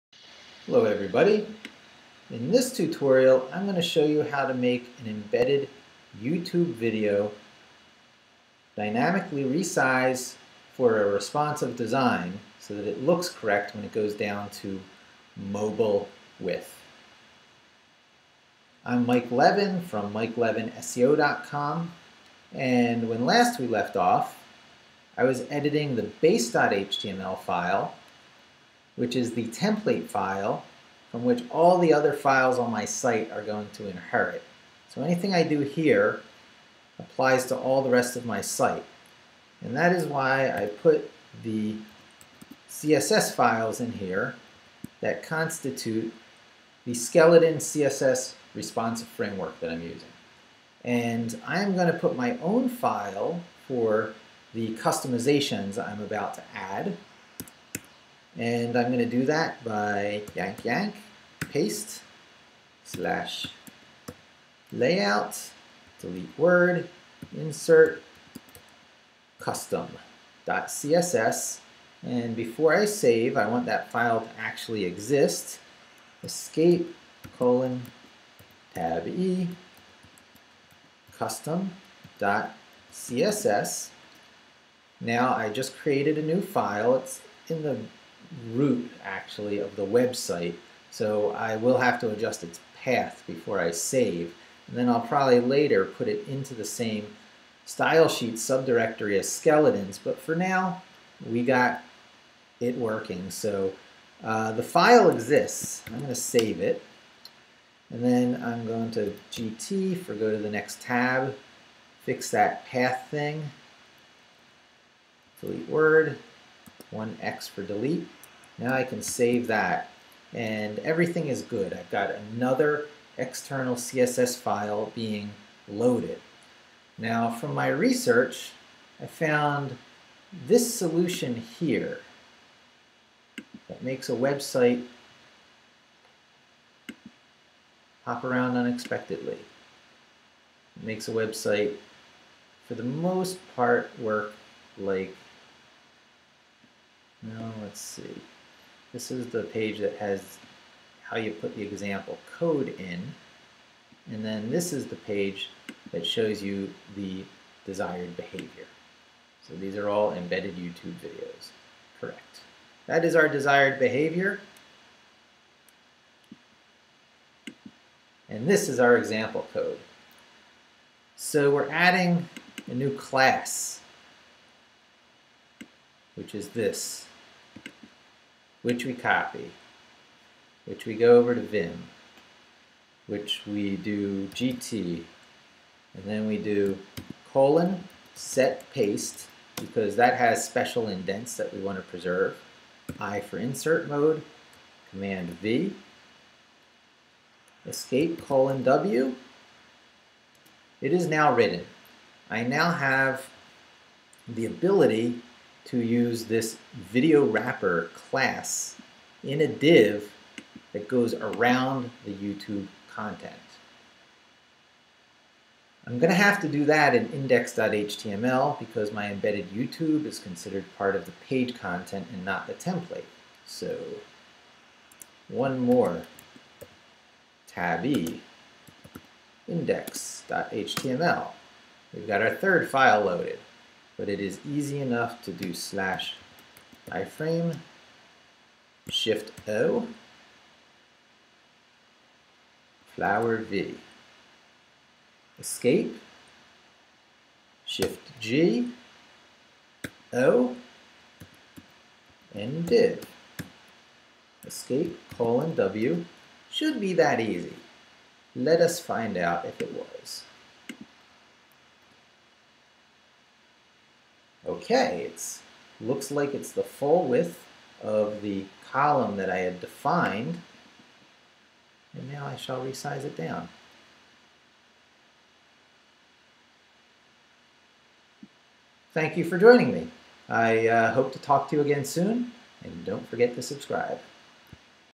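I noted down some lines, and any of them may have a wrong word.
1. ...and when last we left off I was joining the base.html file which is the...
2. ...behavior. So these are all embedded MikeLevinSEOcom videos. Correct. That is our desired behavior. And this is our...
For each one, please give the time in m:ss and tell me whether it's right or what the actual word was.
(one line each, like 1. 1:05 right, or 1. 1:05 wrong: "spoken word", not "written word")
1. 0:22 wrong: "editing", not "joining"
2. 2:38 wrong: "YouTube", not "MikeLevinSEOcom".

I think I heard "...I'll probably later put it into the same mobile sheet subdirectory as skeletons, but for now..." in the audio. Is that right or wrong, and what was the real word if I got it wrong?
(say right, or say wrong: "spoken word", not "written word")
wrong: "style", not "mobile".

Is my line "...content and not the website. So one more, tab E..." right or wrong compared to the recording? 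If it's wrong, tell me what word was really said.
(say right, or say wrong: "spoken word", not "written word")
wrong: "template", not "website".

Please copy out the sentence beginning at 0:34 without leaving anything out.
So anything I do here applies to all the rest of my site.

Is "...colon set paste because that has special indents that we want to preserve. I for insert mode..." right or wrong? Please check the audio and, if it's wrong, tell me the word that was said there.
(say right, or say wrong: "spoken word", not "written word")
right.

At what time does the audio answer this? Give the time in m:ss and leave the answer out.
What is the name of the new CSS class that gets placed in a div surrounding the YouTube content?
3:26.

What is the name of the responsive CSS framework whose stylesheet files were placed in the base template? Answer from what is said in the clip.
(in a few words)
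Skeleton.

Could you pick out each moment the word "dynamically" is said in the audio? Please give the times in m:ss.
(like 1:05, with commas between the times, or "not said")
0:08.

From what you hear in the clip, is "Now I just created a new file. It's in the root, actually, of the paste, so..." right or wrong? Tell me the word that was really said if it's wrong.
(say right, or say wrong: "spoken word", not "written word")
wrong: "website", not "paste".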